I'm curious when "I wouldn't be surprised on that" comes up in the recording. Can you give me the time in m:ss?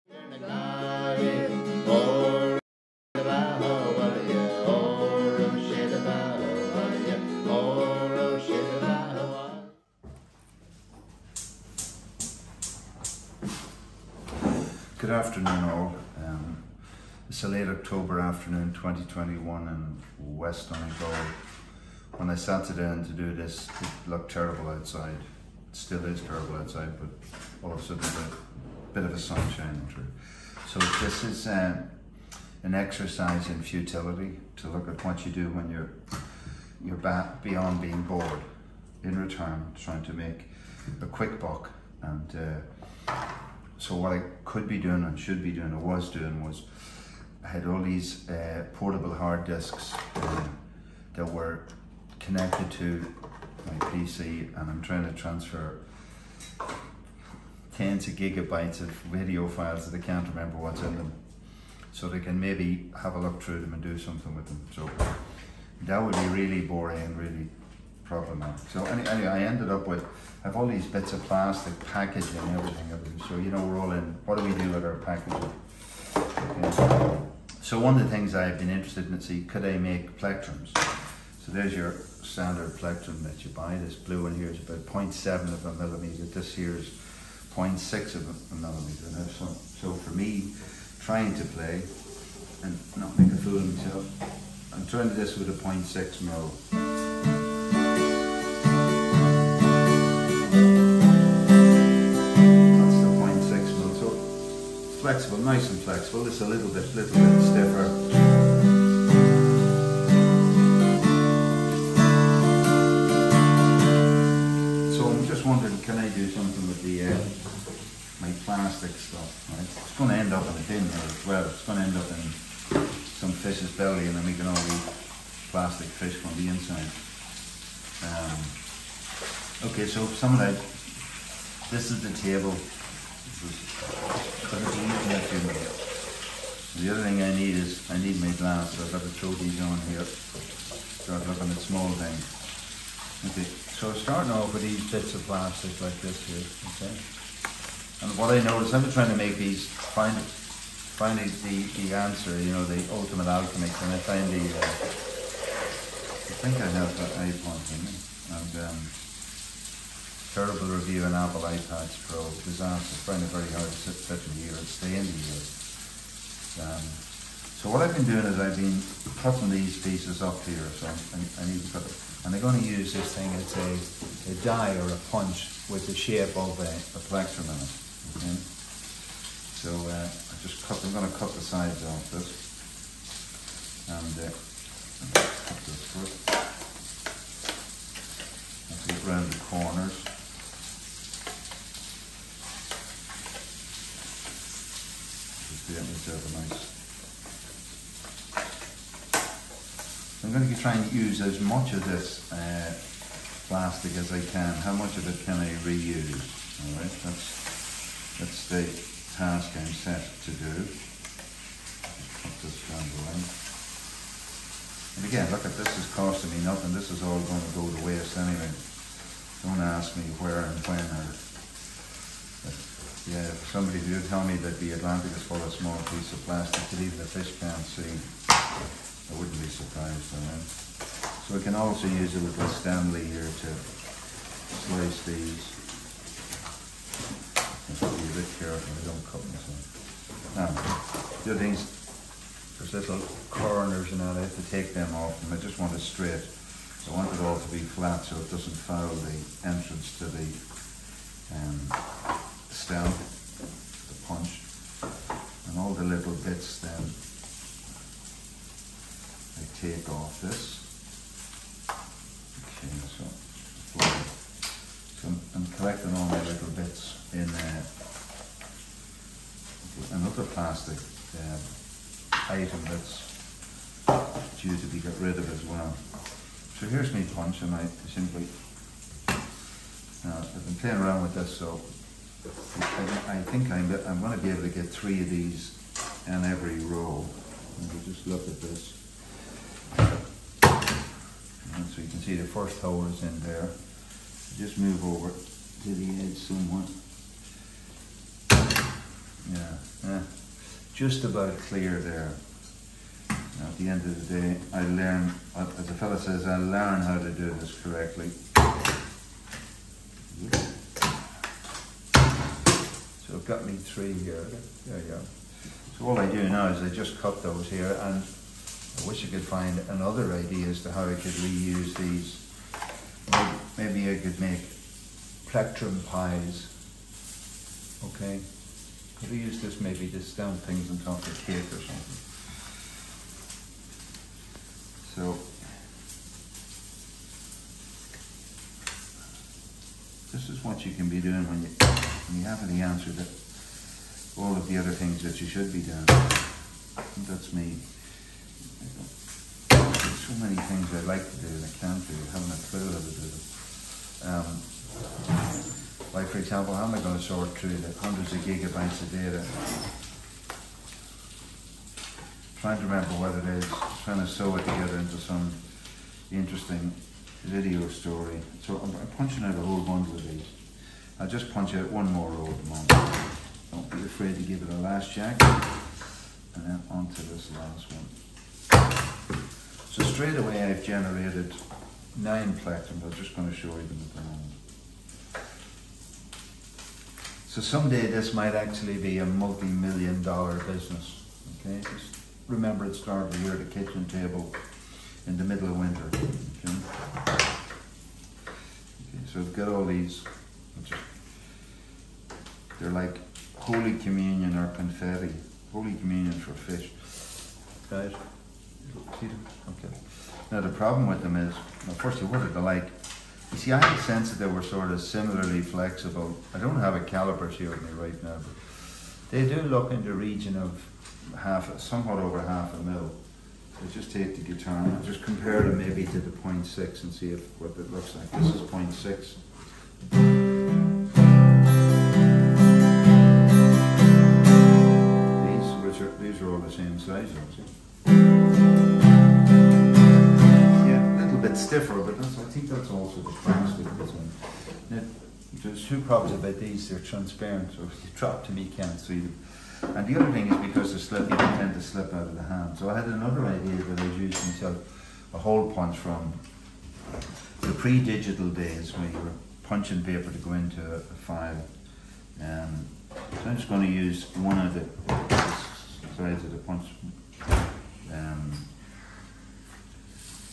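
3:48.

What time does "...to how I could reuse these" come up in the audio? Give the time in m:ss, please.
5:20.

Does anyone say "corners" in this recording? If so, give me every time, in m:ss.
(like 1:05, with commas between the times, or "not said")
3:09, 4:03.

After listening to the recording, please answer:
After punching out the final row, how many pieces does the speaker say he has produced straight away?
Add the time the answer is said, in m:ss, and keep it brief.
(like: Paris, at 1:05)
9, at 6:21.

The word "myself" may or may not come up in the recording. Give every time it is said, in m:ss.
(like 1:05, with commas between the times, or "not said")
1:33, 3:59, 7:34.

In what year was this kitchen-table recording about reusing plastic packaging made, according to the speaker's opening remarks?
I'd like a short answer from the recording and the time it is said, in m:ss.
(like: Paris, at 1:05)
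2021, at 0:18.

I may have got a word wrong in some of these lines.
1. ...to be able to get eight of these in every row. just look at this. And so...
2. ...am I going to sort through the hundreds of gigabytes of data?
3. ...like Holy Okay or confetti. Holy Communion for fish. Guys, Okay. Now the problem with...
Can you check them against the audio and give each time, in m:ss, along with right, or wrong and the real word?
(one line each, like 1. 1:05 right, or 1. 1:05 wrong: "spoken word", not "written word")
1. 4:44 wrong: "three", not "eight"
2. 5:56 right
3. 6:42 wrong: "Communion", not "Okay".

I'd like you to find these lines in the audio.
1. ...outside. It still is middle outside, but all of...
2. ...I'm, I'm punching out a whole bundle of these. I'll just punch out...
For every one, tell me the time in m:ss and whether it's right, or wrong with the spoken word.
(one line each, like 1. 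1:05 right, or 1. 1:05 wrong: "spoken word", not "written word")
1. 0:24 wrong: "terrible", not "middle"
2. 6:08 right.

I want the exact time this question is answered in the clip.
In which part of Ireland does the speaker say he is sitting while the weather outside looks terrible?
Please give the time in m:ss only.
0:20.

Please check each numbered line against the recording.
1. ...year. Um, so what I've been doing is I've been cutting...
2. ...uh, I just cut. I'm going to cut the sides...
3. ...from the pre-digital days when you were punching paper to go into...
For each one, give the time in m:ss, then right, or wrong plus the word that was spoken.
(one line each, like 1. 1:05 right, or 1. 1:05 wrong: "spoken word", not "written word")
1. 2:45 right
2. 2:59 right
3. 7:35 right.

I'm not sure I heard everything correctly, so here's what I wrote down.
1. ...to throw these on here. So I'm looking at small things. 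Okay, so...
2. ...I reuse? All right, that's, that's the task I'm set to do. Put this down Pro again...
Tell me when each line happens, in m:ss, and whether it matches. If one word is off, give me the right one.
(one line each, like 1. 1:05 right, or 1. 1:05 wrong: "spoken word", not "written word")
1. 2:19 right
2. 3:25 wrong: "And", not "Pro".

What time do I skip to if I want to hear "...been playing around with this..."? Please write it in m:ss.
4:40.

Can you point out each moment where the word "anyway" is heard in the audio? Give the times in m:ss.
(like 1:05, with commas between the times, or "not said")
1:09, 3:38.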